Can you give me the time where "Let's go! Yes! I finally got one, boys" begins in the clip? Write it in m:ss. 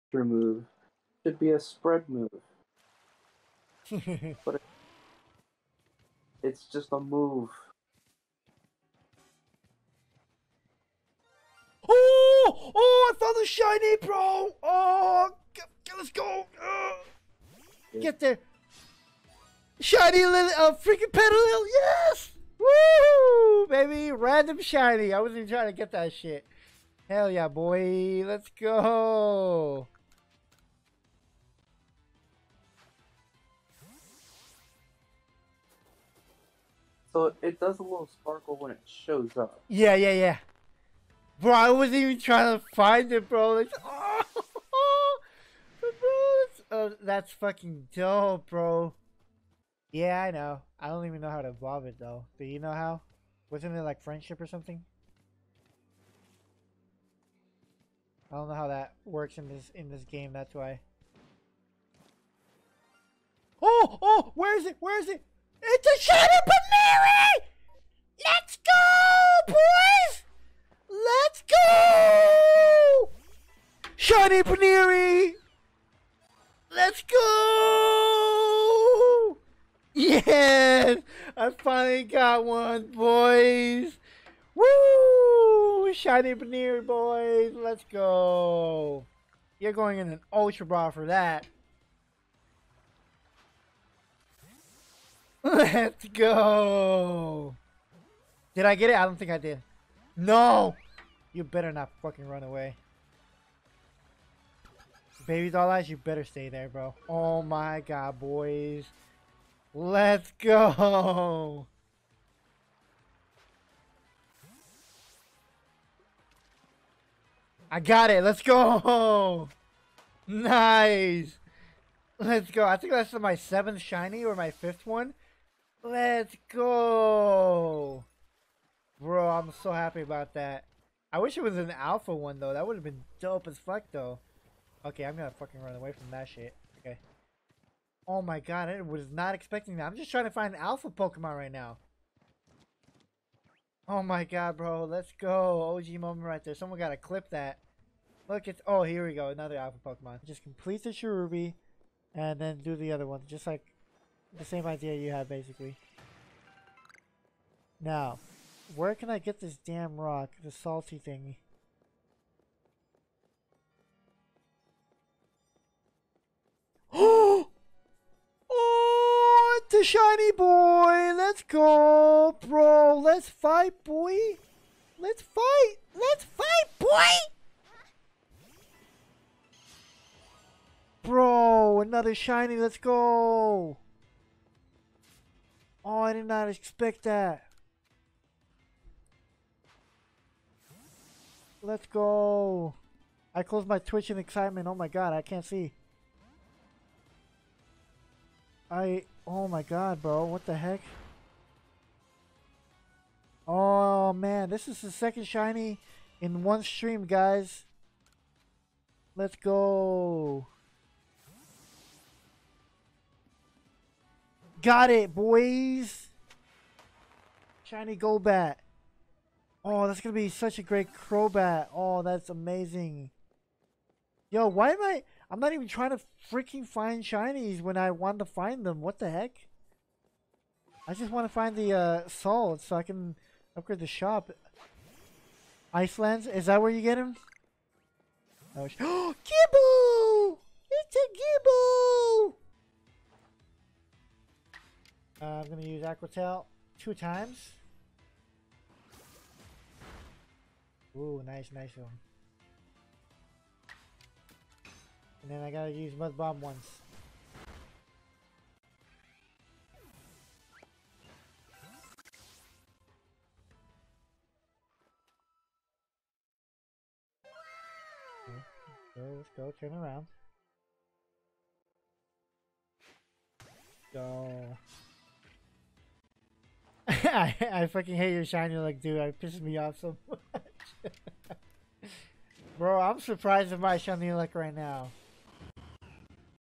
1:16.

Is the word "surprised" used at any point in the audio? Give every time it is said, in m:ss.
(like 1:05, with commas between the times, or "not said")
4:43.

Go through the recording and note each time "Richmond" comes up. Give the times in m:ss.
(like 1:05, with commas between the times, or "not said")
not said.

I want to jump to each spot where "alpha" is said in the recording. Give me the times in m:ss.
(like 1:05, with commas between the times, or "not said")
2:11, 2:20, 2:29.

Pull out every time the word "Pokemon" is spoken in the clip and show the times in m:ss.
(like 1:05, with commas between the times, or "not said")
2:20, 2:29.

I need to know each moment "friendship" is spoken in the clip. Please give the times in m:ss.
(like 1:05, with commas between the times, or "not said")
0:54.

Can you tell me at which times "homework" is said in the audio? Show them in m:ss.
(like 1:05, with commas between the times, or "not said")
not said.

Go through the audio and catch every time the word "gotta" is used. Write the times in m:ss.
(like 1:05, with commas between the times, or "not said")
2:26, 4:15.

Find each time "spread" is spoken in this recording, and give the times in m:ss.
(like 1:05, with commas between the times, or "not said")
0:01.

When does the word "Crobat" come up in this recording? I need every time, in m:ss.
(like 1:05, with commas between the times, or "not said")
3:40.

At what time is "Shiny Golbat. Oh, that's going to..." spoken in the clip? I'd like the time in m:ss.
3:37.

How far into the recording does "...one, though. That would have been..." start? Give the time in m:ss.
2:12.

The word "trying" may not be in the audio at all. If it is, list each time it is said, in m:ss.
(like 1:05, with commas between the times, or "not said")
0:25, 0:42, 2:20, 3:45.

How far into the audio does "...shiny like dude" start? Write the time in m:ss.
4:38.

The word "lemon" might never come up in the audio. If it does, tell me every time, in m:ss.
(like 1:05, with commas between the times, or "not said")
not said.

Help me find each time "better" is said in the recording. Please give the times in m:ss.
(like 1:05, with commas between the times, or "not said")
1:41, 1:45.